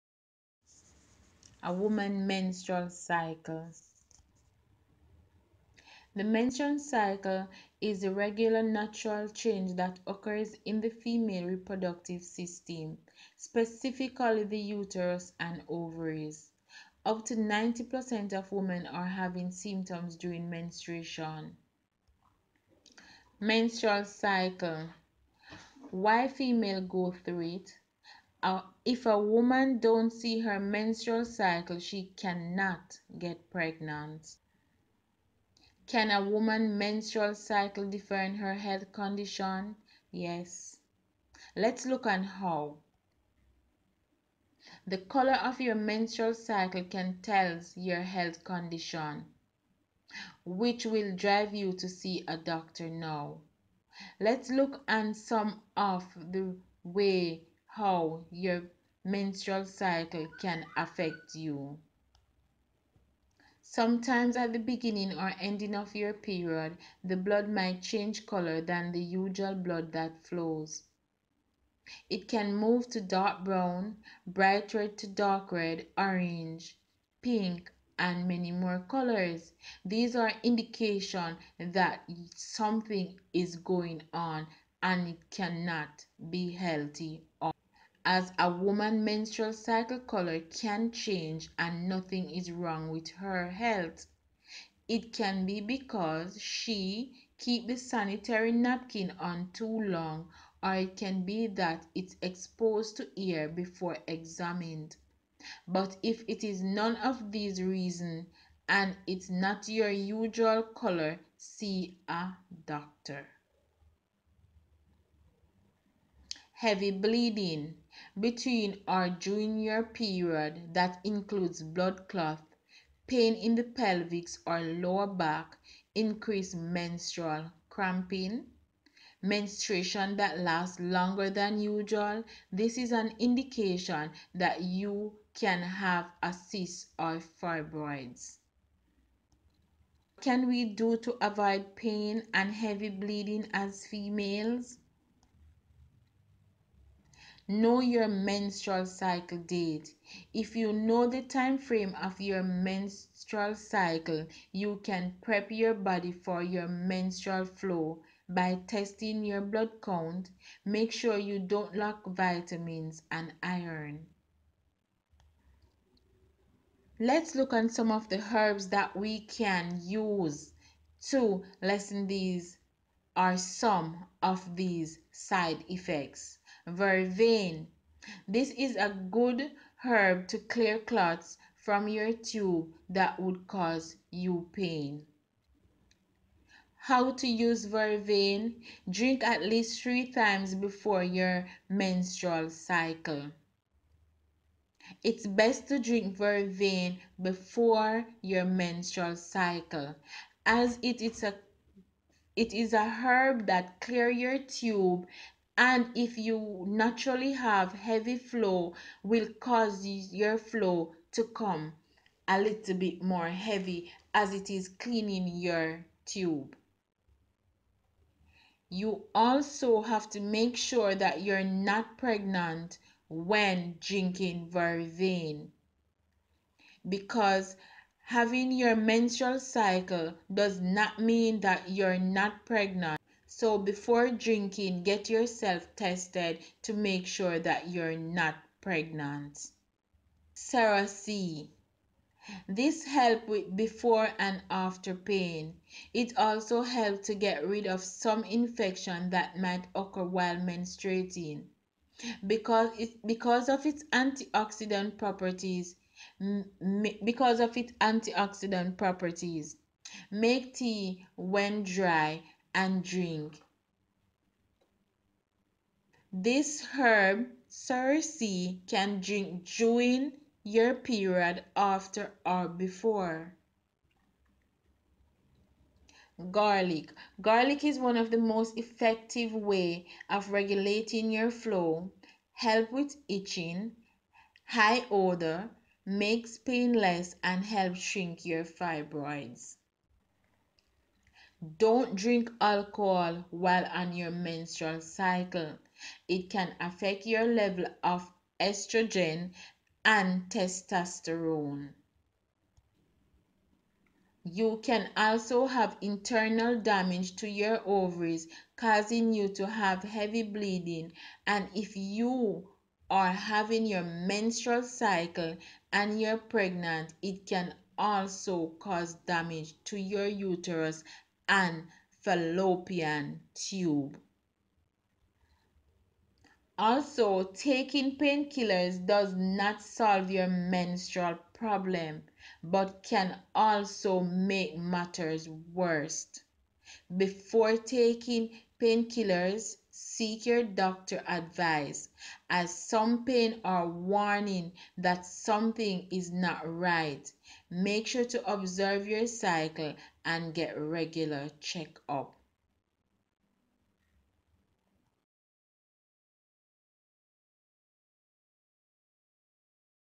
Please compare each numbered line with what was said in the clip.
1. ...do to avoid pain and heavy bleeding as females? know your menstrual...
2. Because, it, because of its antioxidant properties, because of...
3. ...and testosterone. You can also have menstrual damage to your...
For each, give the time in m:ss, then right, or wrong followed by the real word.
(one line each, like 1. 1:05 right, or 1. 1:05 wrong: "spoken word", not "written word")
1. 2:20 right
2. 4:12 right
3. 4:59 wrong: "internal", not "menstrual".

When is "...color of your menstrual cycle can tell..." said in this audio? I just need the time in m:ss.
0:44.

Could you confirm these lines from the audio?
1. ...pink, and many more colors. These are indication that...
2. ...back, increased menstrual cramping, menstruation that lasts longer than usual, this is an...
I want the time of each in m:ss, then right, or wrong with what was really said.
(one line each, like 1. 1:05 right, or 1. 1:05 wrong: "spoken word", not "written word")
1. 1:17 right
2. 2:05 right.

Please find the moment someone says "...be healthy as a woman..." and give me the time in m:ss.
1:26.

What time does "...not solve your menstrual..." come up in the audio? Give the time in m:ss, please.
5:29.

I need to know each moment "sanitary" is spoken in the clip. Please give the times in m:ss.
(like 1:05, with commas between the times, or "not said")
1:37.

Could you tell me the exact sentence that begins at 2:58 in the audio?
This is a good herb to clear clots from your tube that would cause you pain.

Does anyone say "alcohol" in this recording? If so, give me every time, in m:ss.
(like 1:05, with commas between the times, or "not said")
4:52.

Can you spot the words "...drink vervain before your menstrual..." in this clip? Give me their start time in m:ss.
3:15.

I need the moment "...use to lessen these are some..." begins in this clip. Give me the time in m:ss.
2:49.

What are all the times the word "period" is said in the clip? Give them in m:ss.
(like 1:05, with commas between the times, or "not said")
1:06, 1:59, 4:30.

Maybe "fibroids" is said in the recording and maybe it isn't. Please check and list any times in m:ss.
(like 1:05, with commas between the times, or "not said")
2:17, 4:48.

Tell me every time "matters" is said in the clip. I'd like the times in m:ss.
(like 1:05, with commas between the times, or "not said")
5:34.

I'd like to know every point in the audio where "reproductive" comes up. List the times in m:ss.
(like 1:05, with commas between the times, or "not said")
0:11.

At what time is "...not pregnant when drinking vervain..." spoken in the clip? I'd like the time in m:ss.
3:41.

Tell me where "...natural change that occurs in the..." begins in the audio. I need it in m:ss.
0:08.